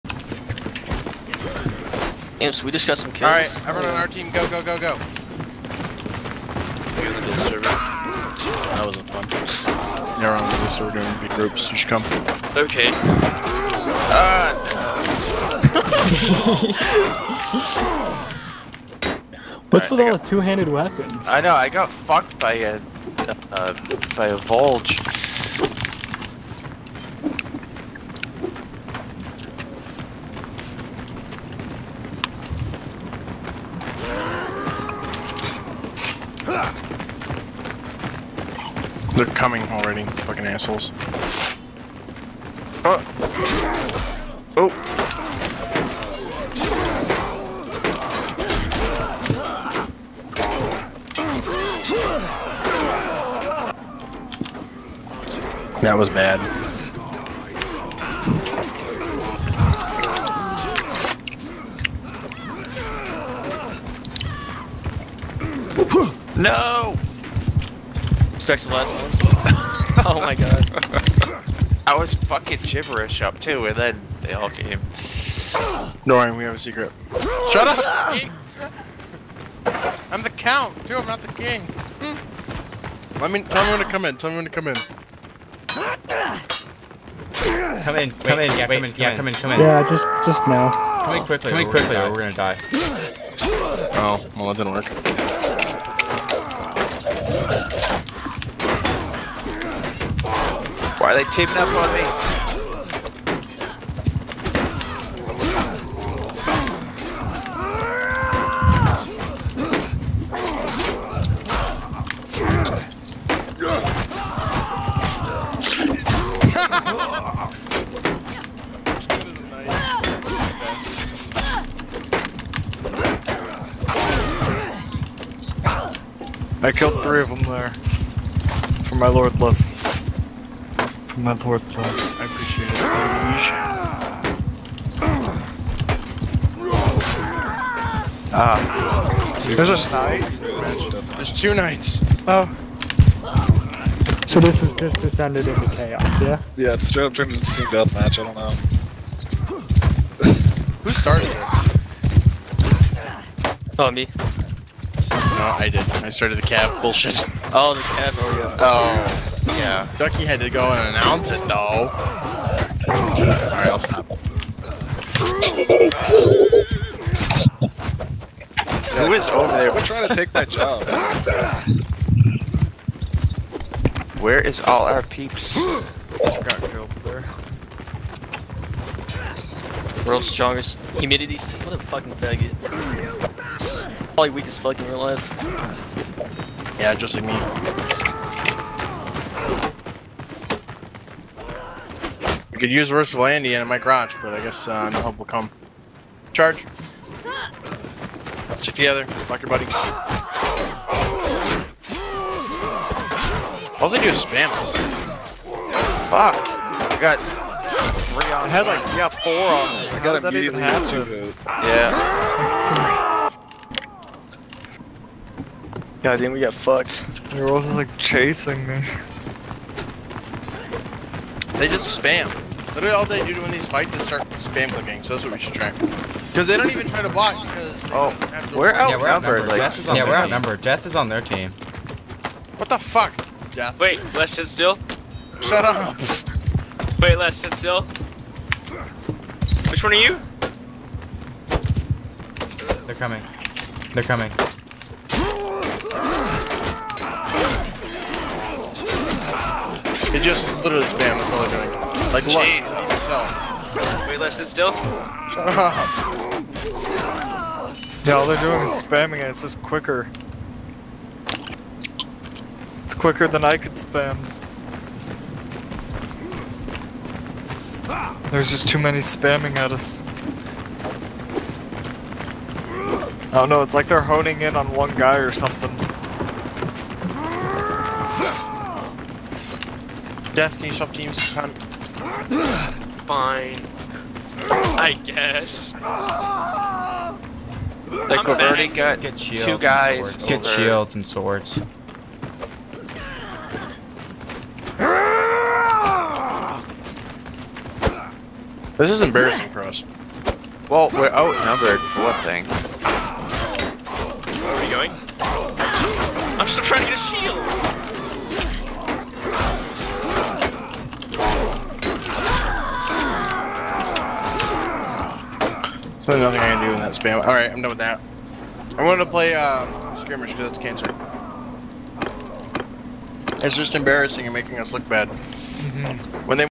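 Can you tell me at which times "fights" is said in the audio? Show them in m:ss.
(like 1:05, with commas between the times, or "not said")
3:43.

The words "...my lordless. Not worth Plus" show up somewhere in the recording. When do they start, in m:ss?
2:08.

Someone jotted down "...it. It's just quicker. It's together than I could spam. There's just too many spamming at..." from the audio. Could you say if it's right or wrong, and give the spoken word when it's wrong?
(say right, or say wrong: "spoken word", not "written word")
wrong: "quicker", not "together".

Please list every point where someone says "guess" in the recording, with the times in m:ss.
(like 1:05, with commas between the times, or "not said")
3:14, 4:45.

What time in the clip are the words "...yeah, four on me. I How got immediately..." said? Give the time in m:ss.
3:28.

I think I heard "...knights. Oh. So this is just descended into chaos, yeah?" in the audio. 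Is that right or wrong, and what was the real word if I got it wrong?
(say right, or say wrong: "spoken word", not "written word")
right.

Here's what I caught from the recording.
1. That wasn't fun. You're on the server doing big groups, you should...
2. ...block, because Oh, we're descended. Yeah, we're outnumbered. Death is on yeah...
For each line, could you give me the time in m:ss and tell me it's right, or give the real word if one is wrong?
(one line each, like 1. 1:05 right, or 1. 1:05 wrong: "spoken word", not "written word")
1. 0:07 right
2. 3:47 wrong: "outnumbered", not "descended".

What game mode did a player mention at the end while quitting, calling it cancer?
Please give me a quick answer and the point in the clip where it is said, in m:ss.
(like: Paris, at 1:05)
Skirmish, at 5:19.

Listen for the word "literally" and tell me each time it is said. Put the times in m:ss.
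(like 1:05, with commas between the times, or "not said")
3:42, 4:10.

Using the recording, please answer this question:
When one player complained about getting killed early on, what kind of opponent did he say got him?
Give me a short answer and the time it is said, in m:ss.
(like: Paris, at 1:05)
Volge, at 0:24.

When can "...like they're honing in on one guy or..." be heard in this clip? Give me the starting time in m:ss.
4:33.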